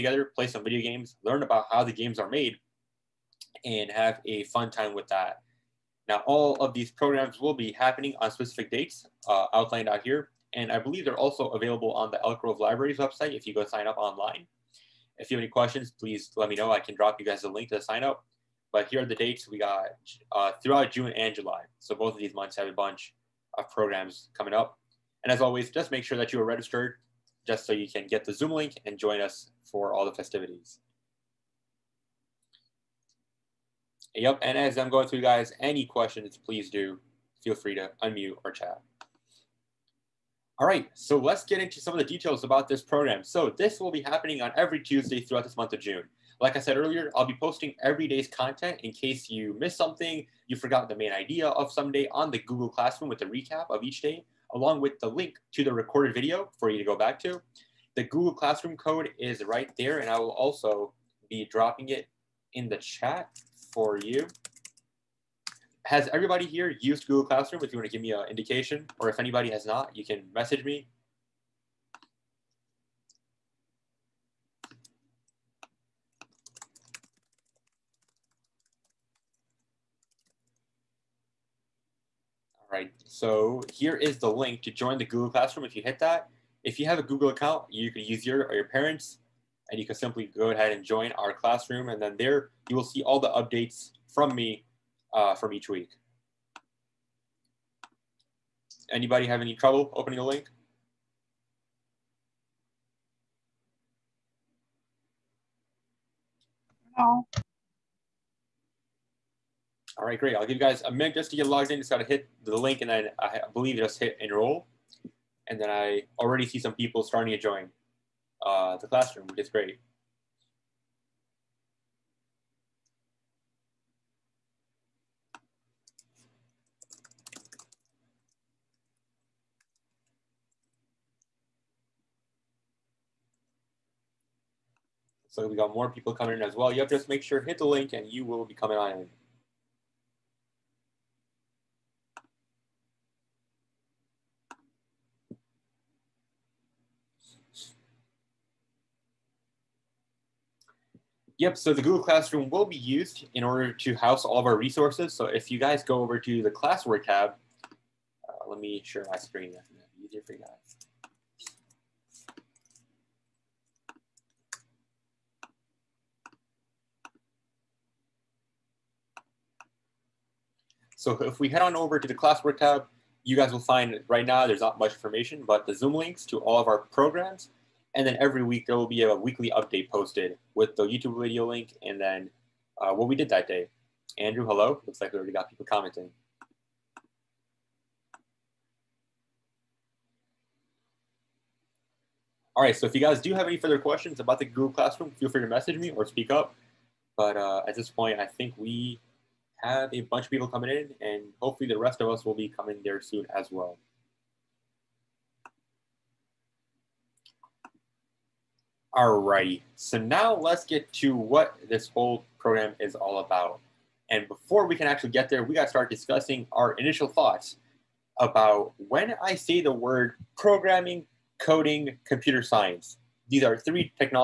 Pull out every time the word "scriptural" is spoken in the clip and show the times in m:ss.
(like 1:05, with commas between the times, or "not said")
not said.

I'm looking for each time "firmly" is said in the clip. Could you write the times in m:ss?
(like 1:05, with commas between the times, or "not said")
not said.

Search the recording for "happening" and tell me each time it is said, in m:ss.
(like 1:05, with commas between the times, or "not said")
0:07, 0:44.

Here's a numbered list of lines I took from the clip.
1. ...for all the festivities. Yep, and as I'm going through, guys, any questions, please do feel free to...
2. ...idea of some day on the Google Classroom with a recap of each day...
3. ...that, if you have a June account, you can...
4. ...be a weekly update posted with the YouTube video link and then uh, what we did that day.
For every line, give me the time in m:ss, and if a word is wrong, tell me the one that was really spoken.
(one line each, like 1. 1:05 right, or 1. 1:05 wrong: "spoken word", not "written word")
1. 0:29 right
2. 0:51 right
3. 1:25 wrong: "Google", not "June"
4. 2:58 right.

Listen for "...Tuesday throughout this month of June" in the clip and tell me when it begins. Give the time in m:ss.
0:44.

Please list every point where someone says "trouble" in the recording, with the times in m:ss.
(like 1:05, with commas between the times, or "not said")
1:39.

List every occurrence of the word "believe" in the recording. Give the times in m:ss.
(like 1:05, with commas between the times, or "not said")
0:10, 1:53.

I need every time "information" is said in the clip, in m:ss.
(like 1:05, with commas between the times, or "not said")
2:54.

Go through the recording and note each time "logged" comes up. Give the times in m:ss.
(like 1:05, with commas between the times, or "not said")
1:51.